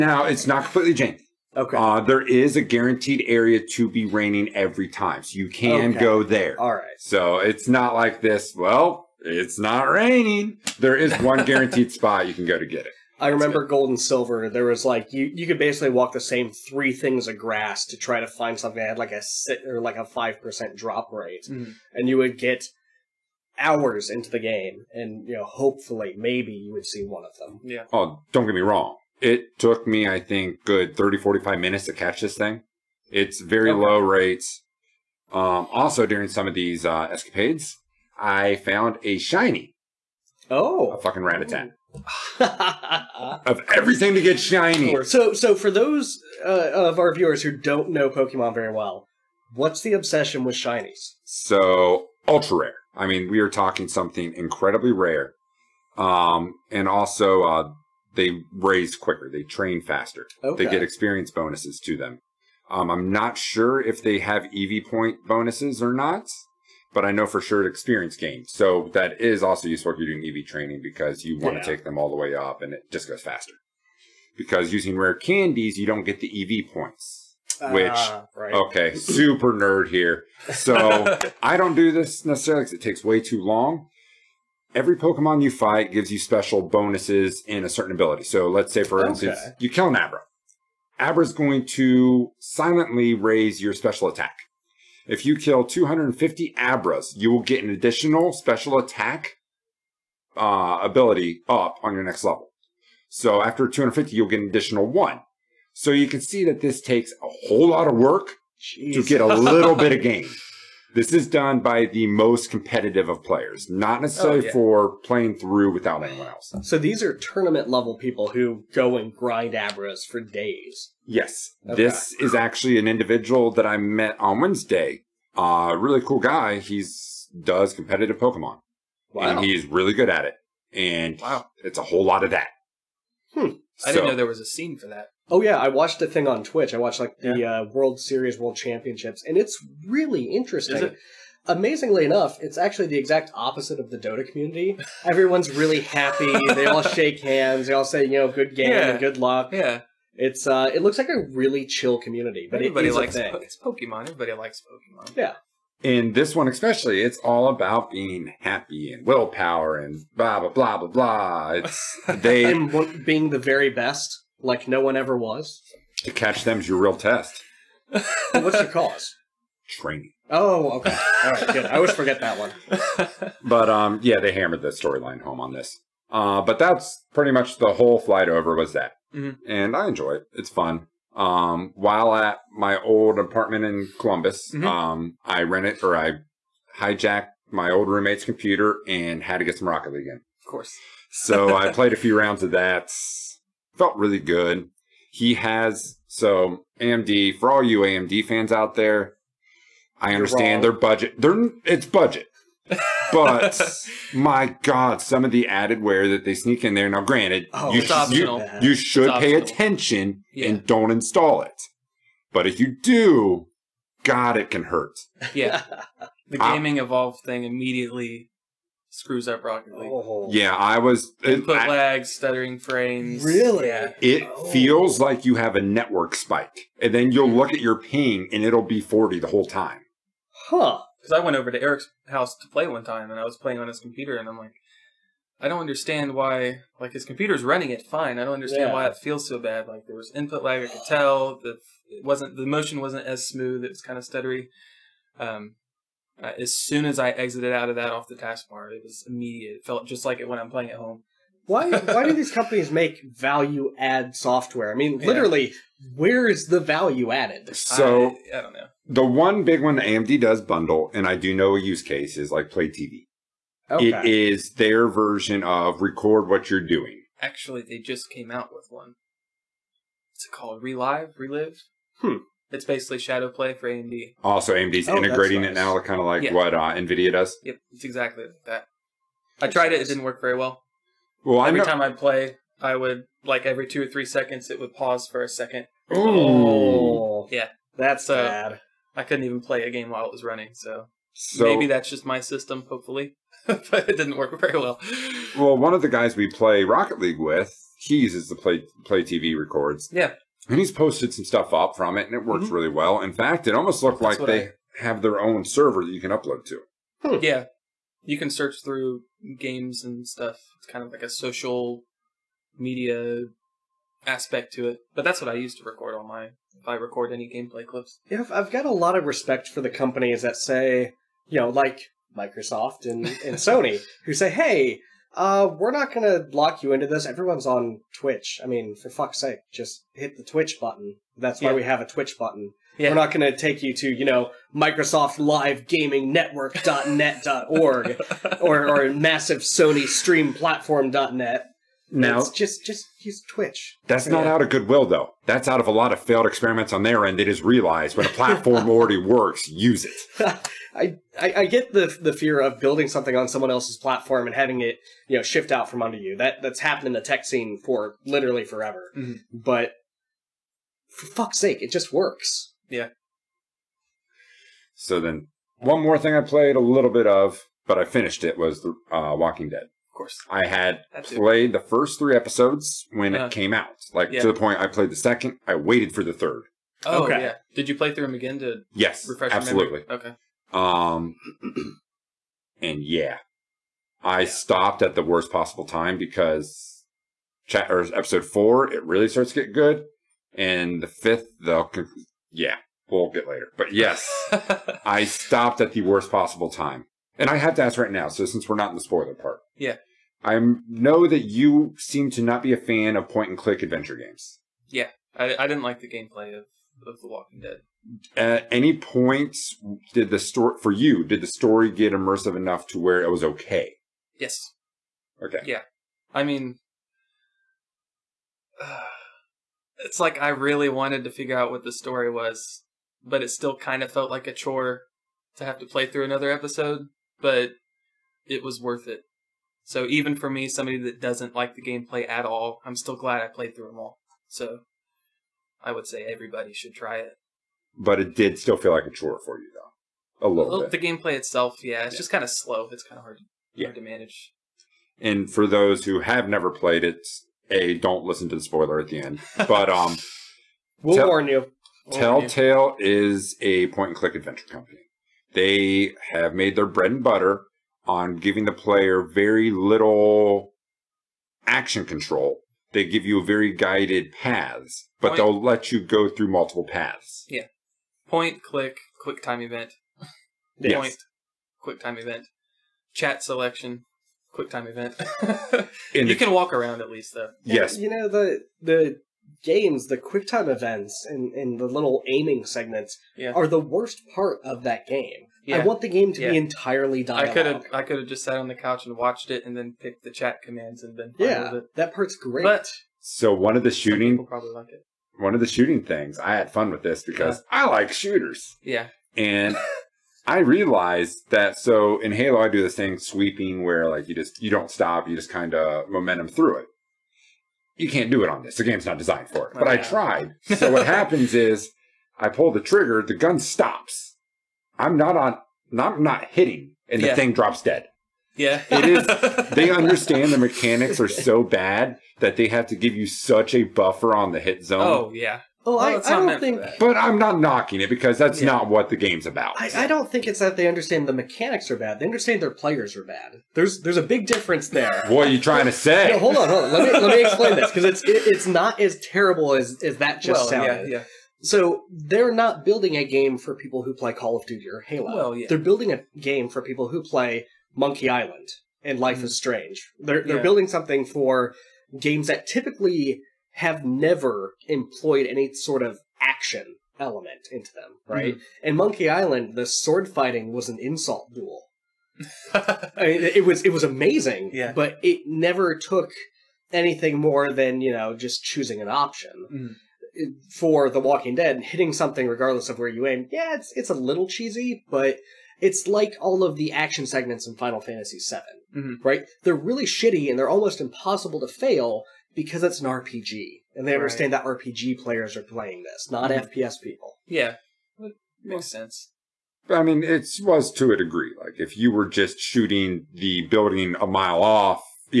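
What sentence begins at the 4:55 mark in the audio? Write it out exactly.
Well, one of the guys we play Rocket League with, he uses the play play TV records.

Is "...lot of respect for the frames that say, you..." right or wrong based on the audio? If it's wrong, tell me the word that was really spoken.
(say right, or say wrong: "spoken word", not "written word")
wrong: "companies", not "frames".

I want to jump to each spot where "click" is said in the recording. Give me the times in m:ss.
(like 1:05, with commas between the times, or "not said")
6:43, 7:33, 7:48.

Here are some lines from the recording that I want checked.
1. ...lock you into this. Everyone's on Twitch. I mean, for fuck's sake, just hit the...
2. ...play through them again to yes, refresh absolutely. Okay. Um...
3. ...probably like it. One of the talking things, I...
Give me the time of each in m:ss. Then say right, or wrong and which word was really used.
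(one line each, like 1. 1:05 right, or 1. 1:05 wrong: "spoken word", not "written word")
1. 5:26 right
2. 6:17 right
3. 8:14 wrong: "shooting", not "talking".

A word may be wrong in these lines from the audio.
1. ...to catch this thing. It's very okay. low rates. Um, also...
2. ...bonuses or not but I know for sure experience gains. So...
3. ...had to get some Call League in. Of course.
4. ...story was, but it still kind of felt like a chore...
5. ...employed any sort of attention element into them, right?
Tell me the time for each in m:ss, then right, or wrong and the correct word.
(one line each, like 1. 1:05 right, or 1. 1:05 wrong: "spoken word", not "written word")
1. 0:31 right
2. 1:05 right
3. 3:09 wrong: "Rocket", not "Call"
4. 7:01 right
5. 9:14 wrong: "action", not "attention".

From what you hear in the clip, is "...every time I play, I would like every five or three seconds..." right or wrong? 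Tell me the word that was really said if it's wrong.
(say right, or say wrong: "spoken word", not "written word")
wrong: "two", not "five".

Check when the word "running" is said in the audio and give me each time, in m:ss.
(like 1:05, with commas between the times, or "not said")
3:57, 4:50.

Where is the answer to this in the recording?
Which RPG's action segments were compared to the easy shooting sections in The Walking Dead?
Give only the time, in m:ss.
9:37.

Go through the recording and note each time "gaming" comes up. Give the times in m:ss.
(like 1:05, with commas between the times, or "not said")
3:36, 5:35.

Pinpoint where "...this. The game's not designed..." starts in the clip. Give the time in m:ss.
8:28.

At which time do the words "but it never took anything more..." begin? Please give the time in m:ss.
9:24.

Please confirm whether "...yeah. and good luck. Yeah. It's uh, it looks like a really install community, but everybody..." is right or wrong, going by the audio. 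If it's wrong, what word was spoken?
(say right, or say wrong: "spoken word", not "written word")
wrong: "chill", not "install".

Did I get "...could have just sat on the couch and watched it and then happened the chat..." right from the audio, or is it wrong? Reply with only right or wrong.
wrong.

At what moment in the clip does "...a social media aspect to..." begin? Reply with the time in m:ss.
5:11.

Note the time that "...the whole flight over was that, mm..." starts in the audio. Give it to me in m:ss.
2:57.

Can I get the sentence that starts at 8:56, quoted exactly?
Let me let me explain this because it's it, it's not as terrible as as that just well, sounded.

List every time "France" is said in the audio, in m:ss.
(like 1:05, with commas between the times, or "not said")
not said.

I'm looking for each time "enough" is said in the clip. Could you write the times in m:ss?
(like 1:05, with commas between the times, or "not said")
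2:22, 6:52.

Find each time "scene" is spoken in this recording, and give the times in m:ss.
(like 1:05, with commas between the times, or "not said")
2:14, 5:57.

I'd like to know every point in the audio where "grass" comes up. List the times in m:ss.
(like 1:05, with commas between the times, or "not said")
0:17.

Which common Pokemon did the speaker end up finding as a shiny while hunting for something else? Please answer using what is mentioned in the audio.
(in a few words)
Rattata.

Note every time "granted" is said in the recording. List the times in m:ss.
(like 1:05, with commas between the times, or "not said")
3:27.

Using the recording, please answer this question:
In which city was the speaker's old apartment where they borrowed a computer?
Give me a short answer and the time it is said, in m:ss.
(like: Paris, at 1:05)
Columbus, at 3:03.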